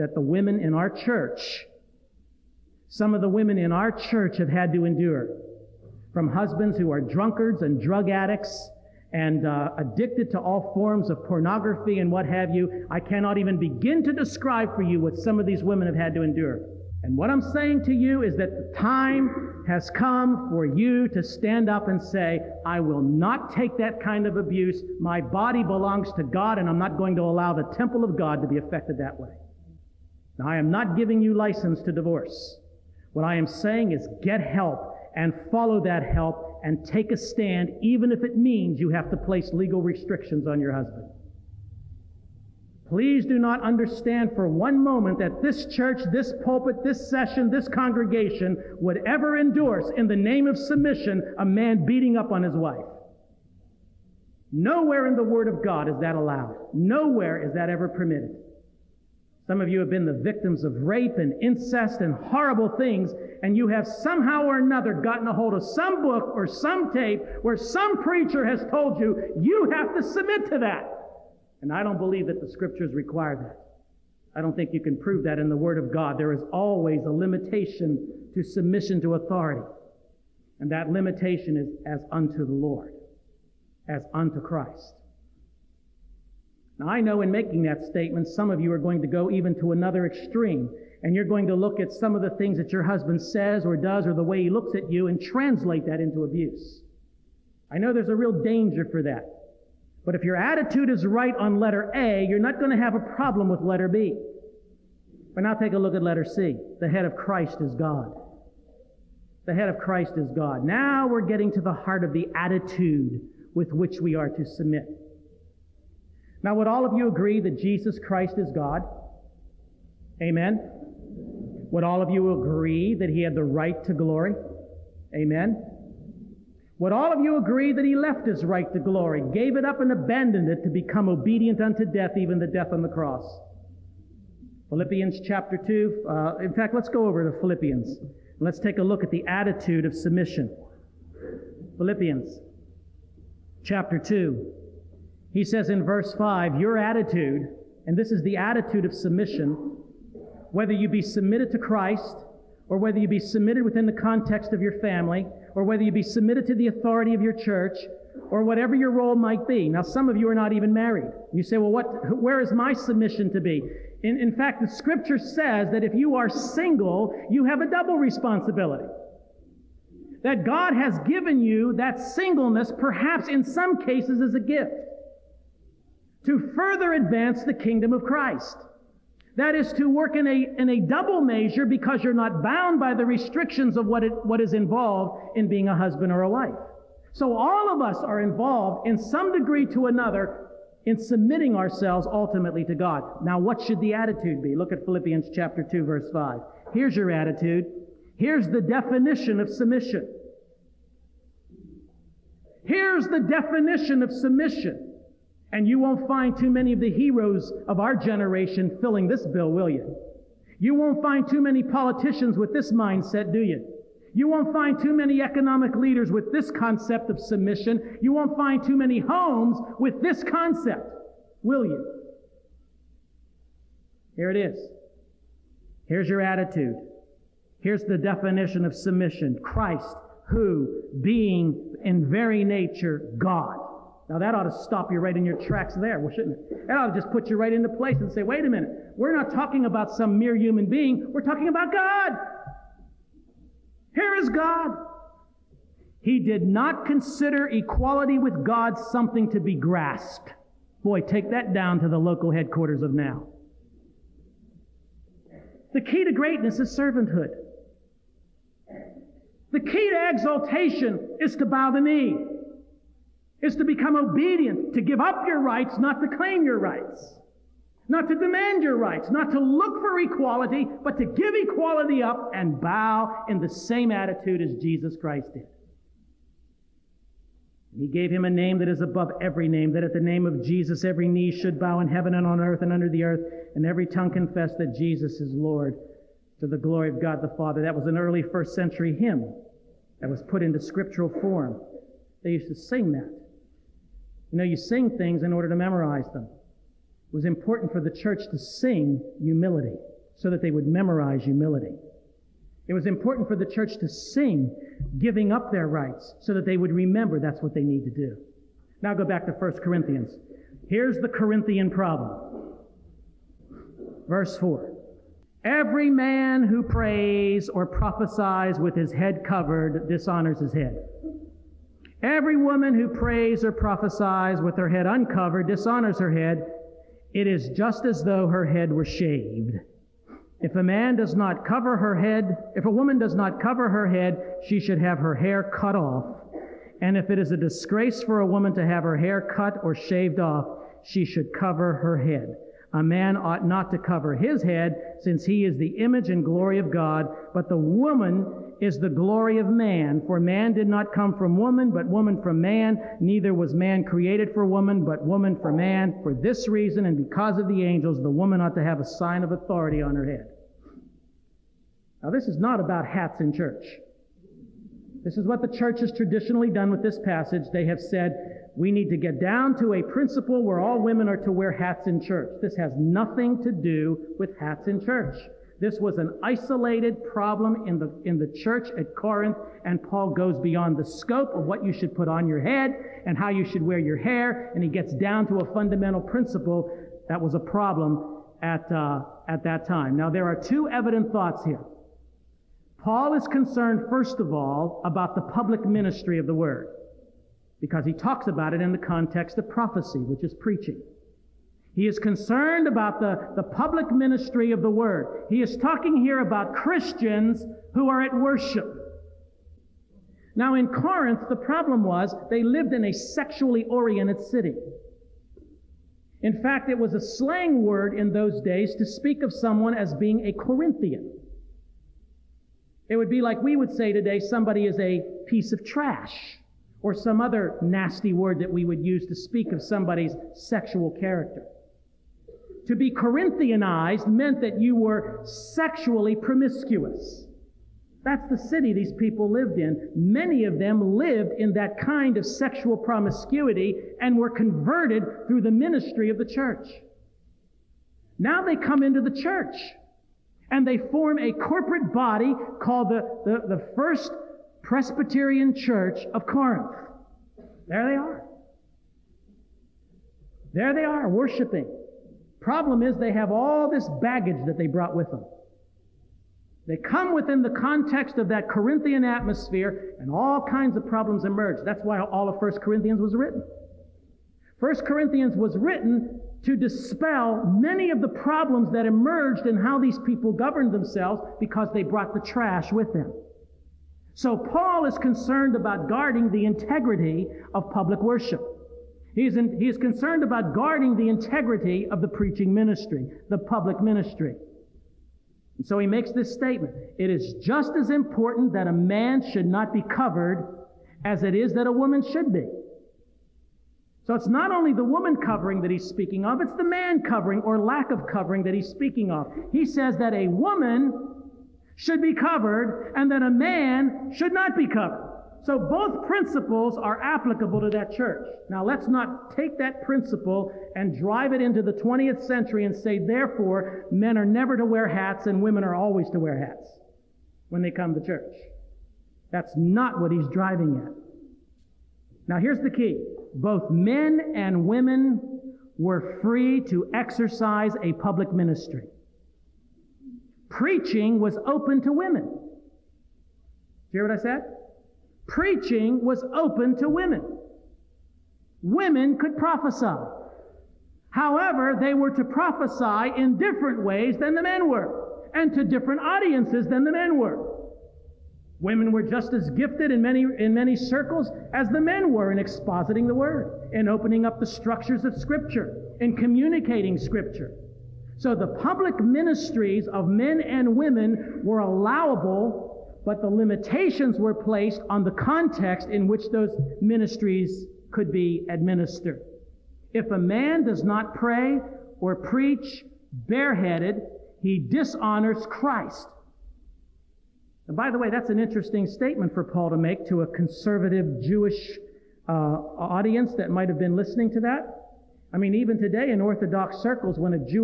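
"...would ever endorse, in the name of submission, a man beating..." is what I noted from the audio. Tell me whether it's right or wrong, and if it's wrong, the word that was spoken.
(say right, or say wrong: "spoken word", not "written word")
right.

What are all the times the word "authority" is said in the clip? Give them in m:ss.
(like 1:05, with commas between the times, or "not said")
1:19, 2:36, 5:59.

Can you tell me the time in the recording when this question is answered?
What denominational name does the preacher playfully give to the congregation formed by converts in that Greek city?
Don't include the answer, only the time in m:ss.
7:33.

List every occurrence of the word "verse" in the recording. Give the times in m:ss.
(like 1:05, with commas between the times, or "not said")
2:25, 3:15, 5:14.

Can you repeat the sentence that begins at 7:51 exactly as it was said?
That's why all of 1 Corinthians was written.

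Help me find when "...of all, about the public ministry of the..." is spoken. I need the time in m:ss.
6:34.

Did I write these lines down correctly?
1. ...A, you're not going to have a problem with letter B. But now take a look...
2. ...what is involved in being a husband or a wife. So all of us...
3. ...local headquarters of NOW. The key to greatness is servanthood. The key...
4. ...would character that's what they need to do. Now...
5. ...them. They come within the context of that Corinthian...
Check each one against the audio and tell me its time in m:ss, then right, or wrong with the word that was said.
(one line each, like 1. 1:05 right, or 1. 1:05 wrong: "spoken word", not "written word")
1. 1:41 right
2. 3:04 right
3. 4:11 right
4. 5:06 wrong: "remember", not "character"
5. 7:45 right.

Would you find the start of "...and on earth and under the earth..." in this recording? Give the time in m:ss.
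4:42.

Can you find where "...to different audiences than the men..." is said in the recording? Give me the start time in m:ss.
9:15.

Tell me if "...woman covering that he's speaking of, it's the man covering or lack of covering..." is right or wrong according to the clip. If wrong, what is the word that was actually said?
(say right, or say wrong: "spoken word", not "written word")
right.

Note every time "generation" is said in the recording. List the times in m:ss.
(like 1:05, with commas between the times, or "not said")
3:27.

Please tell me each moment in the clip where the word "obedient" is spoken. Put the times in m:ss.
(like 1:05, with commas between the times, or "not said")
2:11, 4:23.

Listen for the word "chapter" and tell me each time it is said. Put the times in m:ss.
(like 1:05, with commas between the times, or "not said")
2:15, 2:23, 3:15.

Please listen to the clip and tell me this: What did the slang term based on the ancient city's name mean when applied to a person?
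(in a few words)
Sexually promiscuous.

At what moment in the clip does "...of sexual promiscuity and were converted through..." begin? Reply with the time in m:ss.
7:22.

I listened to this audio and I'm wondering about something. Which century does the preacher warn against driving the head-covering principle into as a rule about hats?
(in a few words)
20th century.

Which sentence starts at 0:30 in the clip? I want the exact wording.
Now, I am not giving you license to divorce.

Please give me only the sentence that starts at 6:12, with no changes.
This has nothing to do with hats in church.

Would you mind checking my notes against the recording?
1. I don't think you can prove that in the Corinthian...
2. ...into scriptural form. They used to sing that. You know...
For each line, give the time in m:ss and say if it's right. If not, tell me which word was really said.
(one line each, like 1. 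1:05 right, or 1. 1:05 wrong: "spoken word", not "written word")
1. 1:14 wrong: "Word", not "Corinthian"
2. 4:50 right.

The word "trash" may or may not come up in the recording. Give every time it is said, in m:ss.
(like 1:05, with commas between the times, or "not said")
7:05, 8:02.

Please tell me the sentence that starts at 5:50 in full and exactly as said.
For man did not come from woman, but woman from man.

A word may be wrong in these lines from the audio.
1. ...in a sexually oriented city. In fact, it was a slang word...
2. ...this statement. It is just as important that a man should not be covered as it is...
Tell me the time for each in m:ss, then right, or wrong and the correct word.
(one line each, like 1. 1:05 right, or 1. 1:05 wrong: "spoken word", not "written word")
1. 6:52 right
2. 8:16 right.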